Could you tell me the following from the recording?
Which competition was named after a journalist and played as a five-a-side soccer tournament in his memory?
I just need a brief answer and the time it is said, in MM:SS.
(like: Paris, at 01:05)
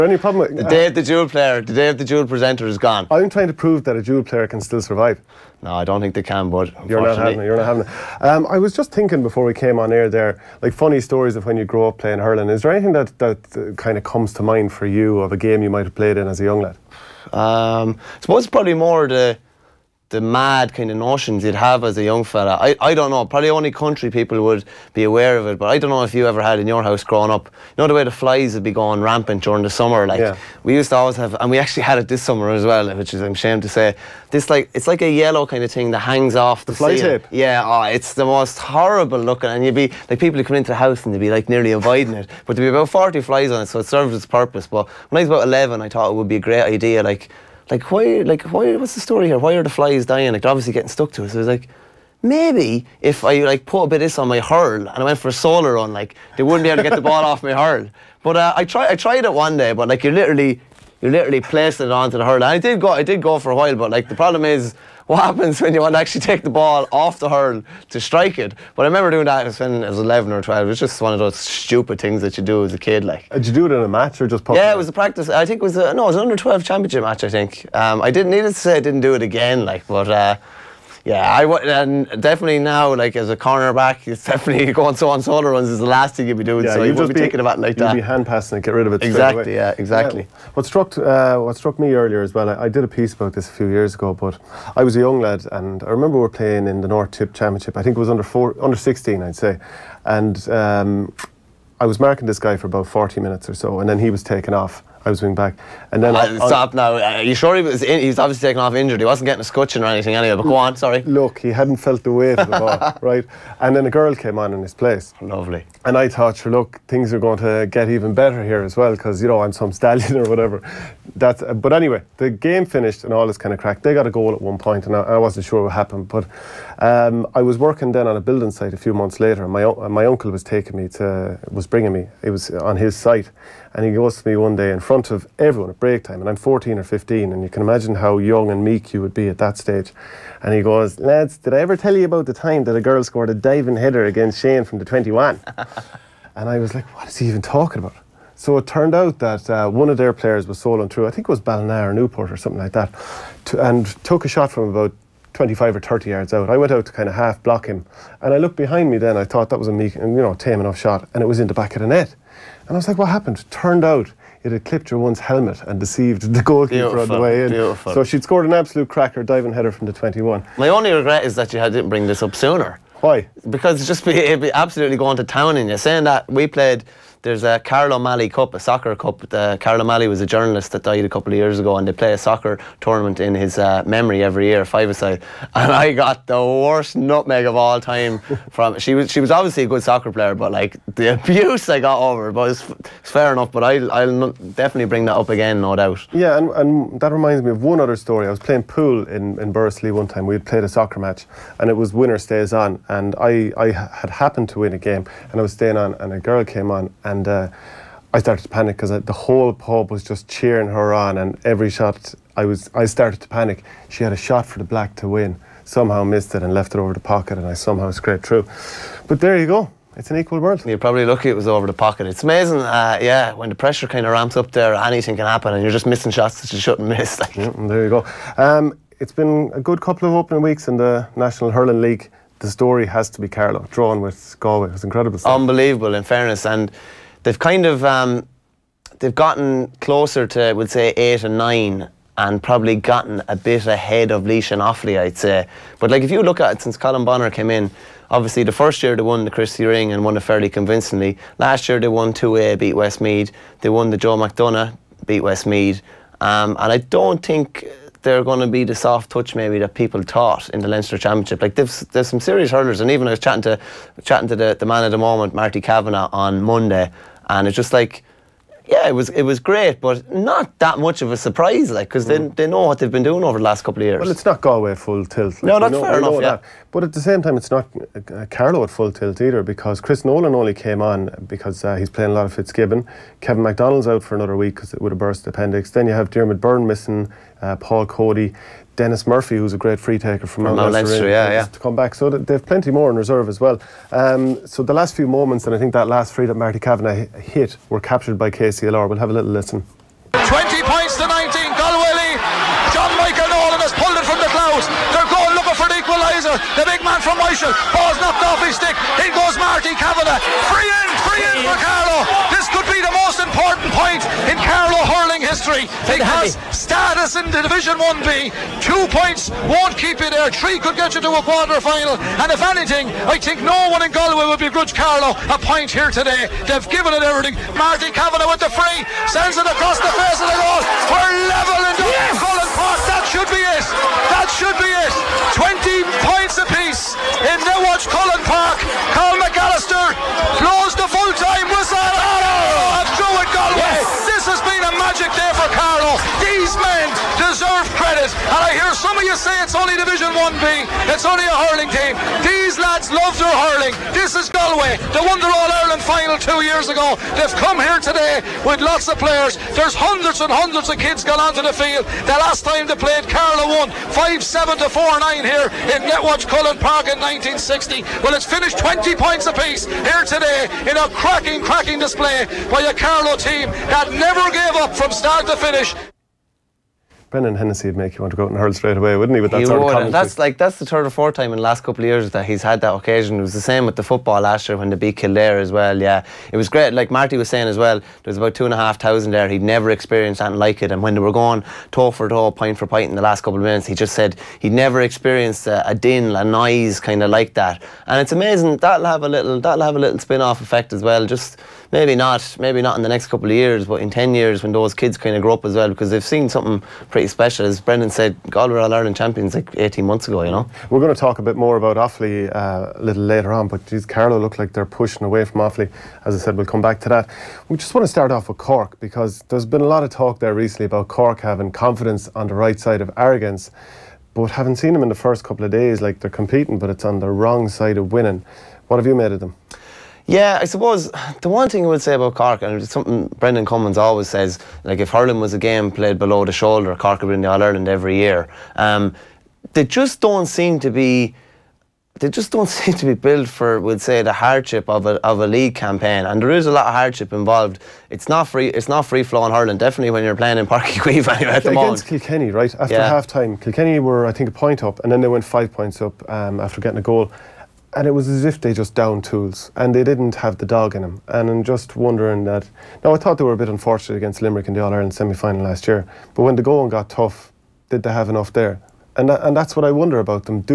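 Carol O'Malley Cup, at 02:57.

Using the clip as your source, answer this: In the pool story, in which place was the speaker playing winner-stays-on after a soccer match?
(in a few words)
Bursley.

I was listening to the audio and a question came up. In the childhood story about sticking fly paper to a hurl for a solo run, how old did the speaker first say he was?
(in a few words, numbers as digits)
11.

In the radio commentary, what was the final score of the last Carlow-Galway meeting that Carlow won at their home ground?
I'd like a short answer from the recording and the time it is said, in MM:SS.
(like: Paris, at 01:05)
5-7 to 4-9, at 06:03.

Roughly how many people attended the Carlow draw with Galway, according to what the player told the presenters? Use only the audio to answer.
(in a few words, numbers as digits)
2,500.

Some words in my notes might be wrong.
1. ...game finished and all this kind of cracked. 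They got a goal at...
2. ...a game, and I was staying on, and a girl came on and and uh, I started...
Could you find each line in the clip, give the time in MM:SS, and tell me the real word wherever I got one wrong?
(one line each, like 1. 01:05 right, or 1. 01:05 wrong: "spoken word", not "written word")
1. 02:02 right
2. 03:24 right.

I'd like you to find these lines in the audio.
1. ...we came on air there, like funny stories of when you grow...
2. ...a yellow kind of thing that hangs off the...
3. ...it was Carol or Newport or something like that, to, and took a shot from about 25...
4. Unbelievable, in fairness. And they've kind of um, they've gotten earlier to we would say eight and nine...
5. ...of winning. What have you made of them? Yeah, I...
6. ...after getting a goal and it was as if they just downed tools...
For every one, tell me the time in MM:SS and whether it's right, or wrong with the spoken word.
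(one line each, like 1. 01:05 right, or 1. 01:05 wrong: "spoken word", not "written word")
1. 00:09 right
2. 00:35 right
3. 02:31 wrong: "Balna", not "Carol"
4. 03:55 wrong: "closer", not "earlier"
5. 07:07 right
6. 07:36 right.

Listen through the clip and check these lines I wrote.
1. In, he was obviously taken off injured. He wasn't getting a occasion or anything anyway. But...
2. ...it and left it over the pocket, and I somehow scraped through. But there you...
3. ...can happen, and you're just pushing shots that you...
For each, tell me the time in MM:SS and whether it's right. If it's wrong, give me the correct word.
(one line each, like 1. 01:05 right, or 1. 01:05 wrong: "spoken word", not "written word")
1. 01:47 wrong: "scutcheon", not "occasion"
2. 03:36 right
3. 03:45 wrong: "missing", not "pushing".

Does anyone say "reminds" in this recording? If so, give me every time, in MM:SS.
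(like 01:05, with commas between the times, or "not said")
03:17.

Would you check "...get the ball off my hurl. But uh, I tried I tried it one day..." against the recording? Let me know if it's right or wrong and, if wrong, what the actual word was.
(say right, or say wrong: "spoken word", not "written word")
right.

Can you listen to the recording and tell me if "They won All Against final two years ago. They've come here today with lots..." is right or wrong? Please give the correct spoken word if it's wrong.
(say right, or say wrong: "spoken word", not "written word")
wrong: "Ireland", not "Against".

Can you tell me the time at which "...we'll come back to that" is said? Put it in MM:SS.
06:56.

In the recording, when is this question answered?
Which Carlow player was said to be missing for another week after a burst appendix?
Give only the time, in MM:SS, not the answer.
04:43.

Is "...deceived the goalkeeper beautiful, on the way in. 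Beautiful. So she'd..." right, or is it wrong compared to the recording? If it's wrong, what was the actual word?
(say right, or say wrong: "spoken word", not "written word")
right.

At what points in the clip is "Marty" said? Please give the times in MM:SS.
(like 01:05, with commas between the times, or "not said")
04:25, 04:56, 05:09, 05:27, 06:26.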